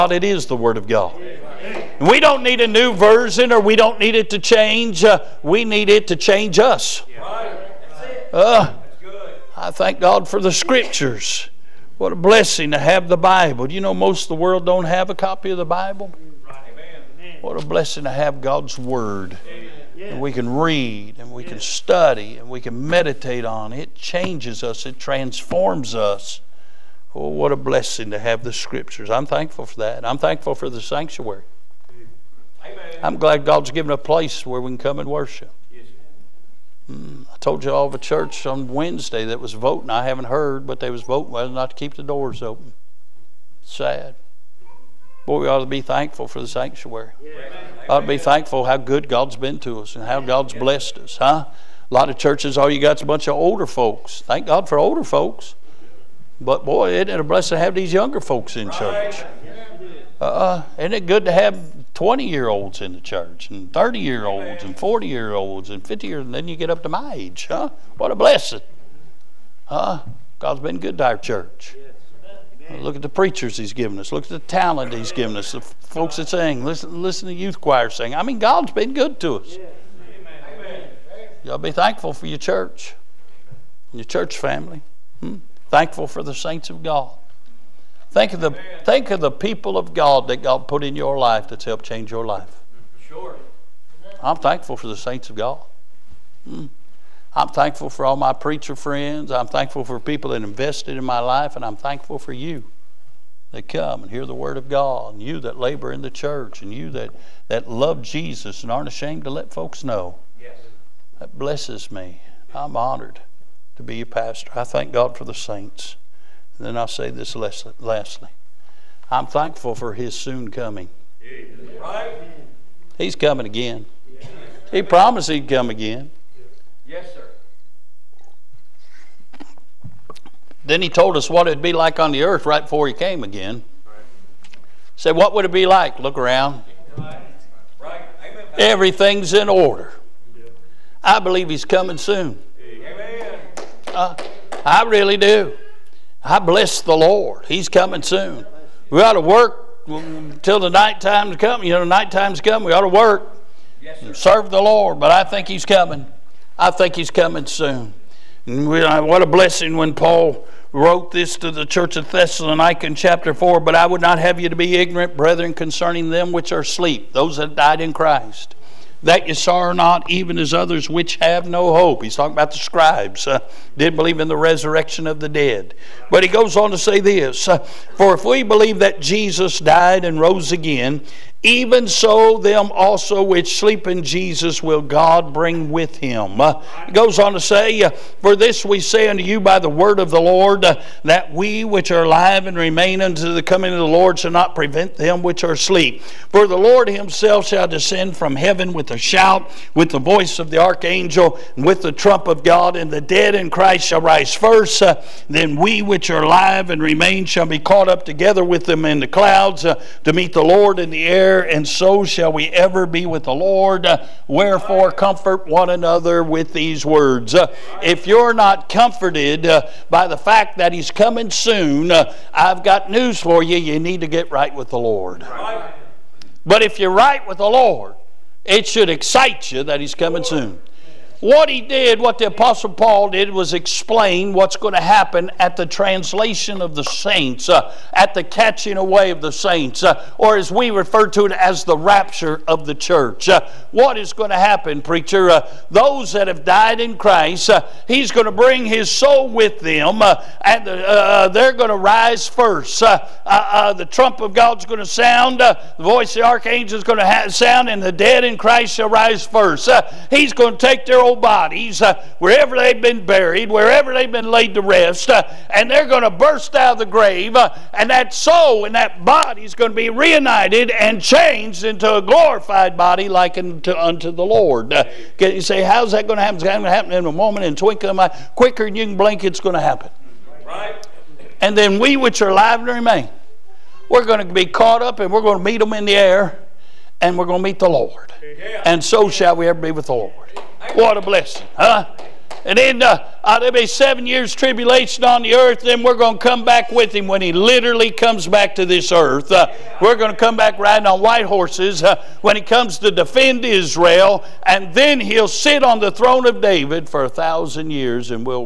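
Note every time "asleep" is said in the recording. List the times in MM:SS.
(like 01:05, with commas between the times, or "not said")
02:46, 03:15.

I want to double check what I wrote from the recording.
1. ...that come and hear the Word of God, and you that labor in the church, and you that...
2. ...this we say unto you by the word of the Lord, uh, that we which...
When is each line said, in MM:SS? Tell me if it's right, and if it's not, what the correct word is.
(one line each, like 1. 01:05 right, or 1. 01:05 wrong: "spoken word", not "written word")
1. 01:43 right
2. 03:08 right.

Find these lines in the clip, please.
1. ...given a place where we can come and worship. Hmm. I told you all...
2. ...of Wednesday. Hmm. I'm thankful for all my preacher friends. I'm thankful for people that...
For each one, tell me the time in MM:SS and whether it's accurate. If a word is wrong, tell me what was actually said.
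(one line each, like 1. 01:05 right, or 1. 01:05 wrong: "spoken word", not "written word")
1. 00:33 right
2. 01:35 wrong: "God", not "Wednesday".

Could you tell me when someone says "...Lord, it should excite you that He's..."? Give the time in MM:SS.
03:47.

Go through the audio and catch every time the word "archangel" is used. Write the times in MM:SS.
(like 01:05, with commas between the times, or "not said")
03:20, 04:16.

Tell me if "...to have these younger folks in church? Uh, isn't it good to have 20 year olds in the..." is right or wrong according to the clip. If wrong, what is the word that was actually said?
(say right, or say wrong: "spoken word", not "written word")
right.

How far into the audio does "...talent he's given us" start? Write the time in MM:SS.
01:14.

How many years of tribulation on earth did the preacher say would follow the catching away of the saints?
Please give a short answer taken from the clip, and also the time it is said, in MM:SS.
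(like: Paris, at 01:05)
7, at 04:53.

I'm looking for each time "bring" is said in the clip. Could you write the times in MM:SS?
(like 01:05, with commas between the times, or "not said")
03:05, 04:08.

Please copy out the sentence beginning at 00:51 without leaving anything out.
A lot of churches, all you got's a bunch of older folks.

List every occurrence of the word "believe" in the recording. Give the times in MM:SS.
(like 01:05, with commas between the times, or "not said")
02:21, 02:53, 02:58.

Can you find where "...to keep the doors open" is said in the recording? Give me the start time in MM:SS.
00:41.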